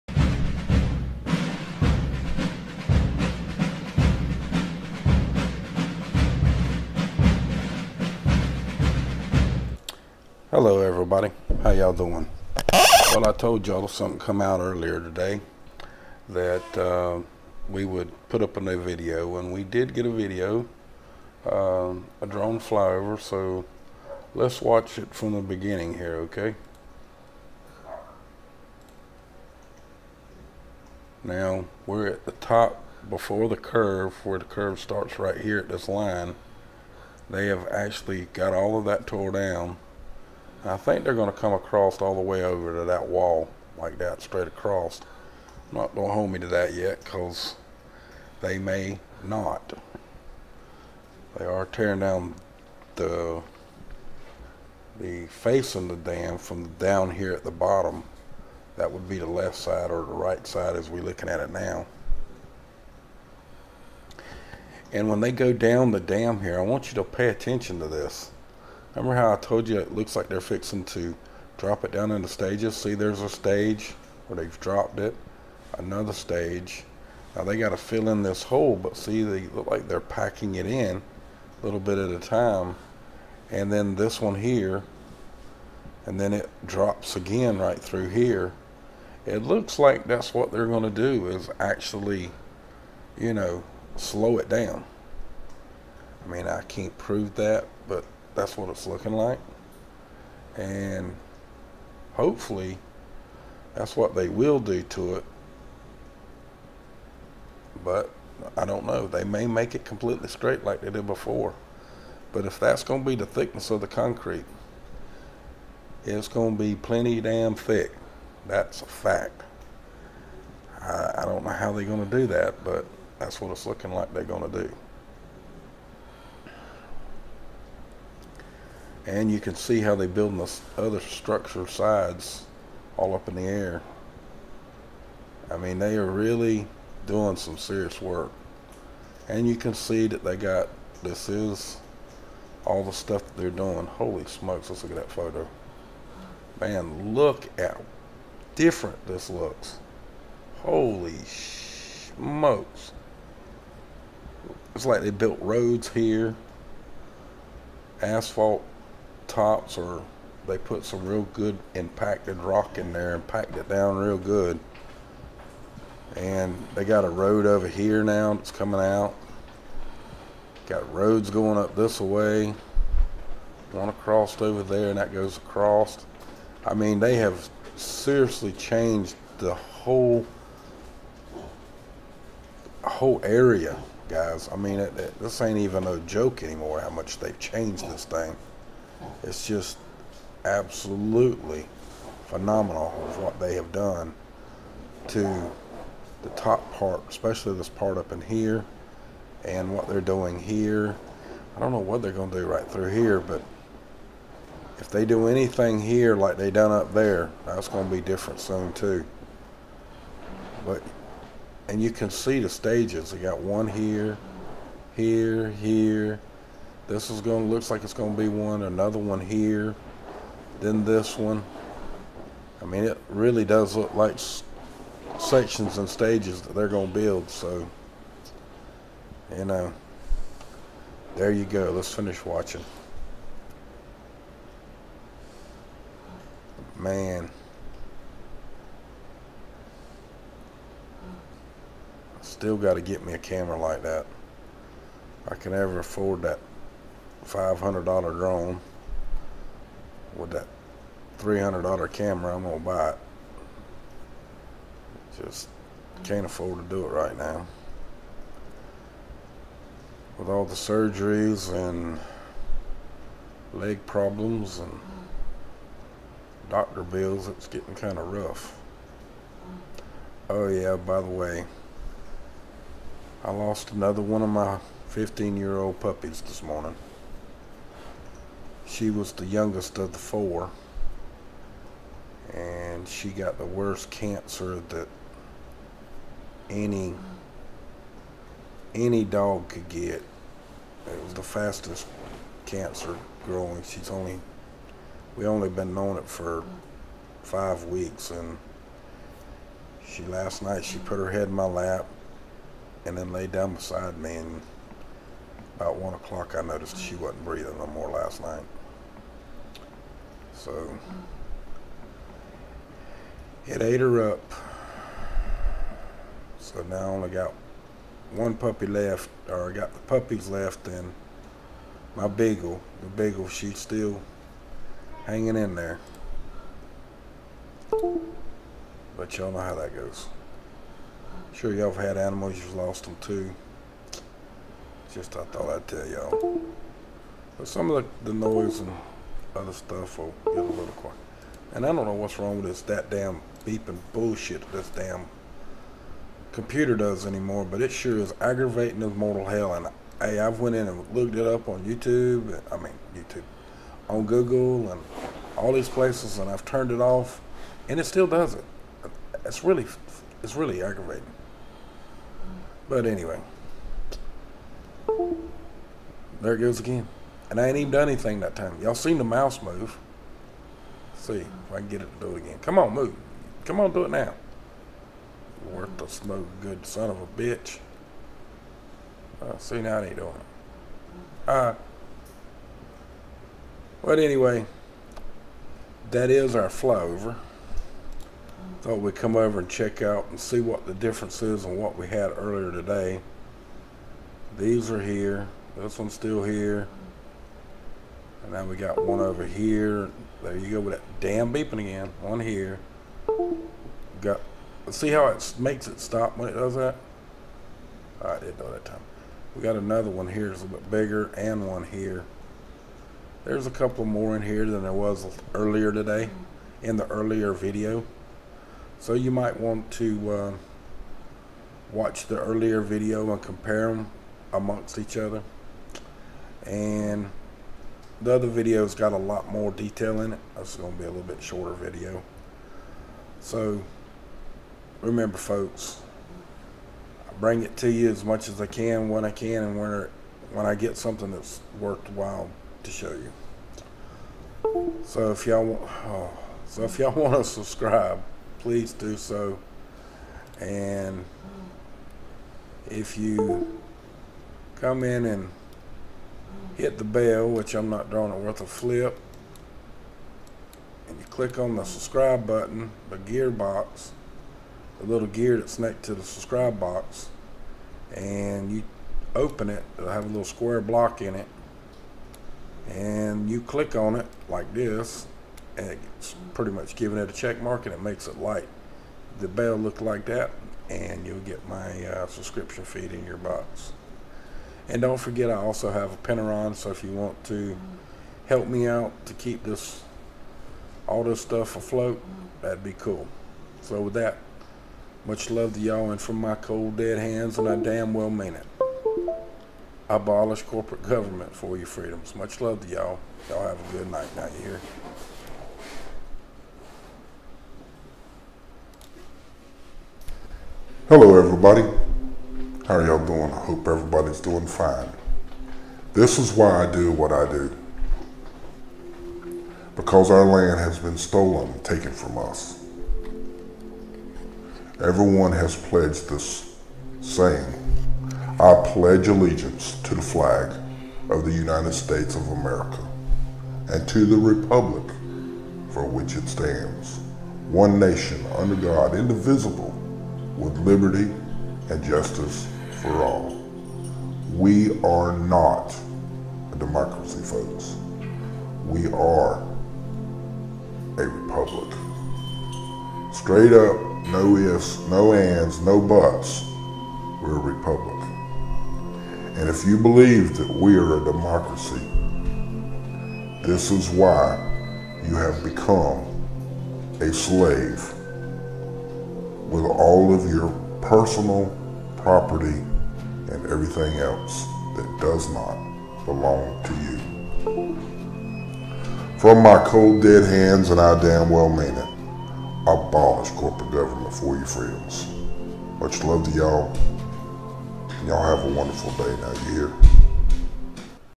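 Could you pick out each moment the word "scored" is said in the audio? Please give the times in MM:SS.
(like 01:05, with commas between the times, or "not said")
not said.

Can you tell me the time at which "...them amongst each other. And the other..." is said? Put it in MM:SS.
07:03.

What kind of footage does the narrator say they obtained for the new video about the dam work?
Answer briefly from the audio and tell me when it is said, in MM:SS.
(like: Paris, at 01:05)
Drone flyover, at 00:22.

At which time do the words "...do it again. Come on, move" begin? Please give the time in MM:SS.
06:12.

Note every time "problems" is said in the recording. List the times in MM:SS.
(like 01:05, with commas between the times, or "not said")
04:23.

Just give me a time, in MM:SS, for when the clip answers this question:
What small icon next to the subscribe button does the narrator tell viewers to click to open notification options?
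07:44.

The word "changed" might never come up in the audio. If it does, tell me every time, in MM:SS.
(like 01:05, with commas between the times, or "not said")
02:58, 03:07.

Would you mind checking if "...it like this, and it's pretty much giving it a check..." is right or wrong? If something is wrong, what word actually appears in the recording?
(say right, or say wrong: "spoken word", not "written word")
right.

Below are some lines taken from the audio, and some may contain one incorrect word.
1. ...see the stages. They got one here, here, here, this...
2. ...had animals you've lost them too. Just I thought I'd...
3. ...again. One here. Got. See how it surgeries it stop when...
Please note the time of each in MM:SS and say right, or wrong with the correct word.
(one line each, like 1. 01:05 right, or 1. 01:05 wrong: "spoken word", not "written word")
1. 03:32 right
2. 05:31 right
3. 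06:41 wrong: "makes", not "surgeries".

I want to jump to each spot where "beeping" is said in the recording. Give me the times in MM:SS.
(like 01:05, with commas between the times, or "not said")
05:43, 06:41.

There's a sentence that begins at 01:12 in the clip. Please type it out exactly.
See, there's a stage where they've dropped it, another stage.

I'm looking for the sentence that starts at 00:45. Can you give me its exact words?
I'm not going to hold me to that yet because they may not.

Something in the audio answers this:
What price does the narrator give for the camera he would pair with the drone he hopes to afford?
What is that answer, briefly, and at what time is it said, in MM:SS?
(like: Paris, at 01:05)
$300, at 04:11.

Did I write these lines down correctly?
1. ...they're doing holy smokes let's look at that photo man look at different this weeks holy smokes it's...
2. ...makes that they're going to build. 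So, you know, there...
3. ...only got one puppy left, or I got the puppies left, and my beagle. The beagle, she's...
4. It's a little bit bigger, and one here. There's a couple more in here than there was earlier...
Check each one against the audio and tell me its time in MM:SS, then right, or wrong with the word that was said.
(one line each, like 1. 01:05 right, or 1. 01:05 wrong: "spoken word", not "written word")
1. 02:23 wrong: "looks", not "weeks"
2. 03:45 wrong: "stages", not "makes"
3. 05:16 right
4. 06:50 right.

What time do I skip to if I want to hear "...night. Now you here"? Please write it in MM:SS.
08:23.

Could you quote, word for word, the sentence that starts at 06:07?
And I ain't even done anything that time.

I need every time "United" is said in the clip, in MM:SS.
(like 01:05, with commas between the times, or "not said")
08:51.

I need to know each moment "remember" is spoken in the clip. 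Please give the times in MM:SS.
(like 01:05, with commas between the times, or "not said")
01:08, 07:14.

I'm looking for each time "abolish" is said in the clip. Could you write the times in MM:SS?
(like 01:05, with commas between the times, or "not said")
08:19, 09:42.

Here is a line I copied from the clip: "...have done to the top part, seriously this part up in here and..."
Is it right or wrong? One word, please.
wrong.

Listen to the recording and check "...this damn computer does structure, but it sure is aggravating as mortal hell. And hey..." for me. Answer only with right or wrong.
wrong.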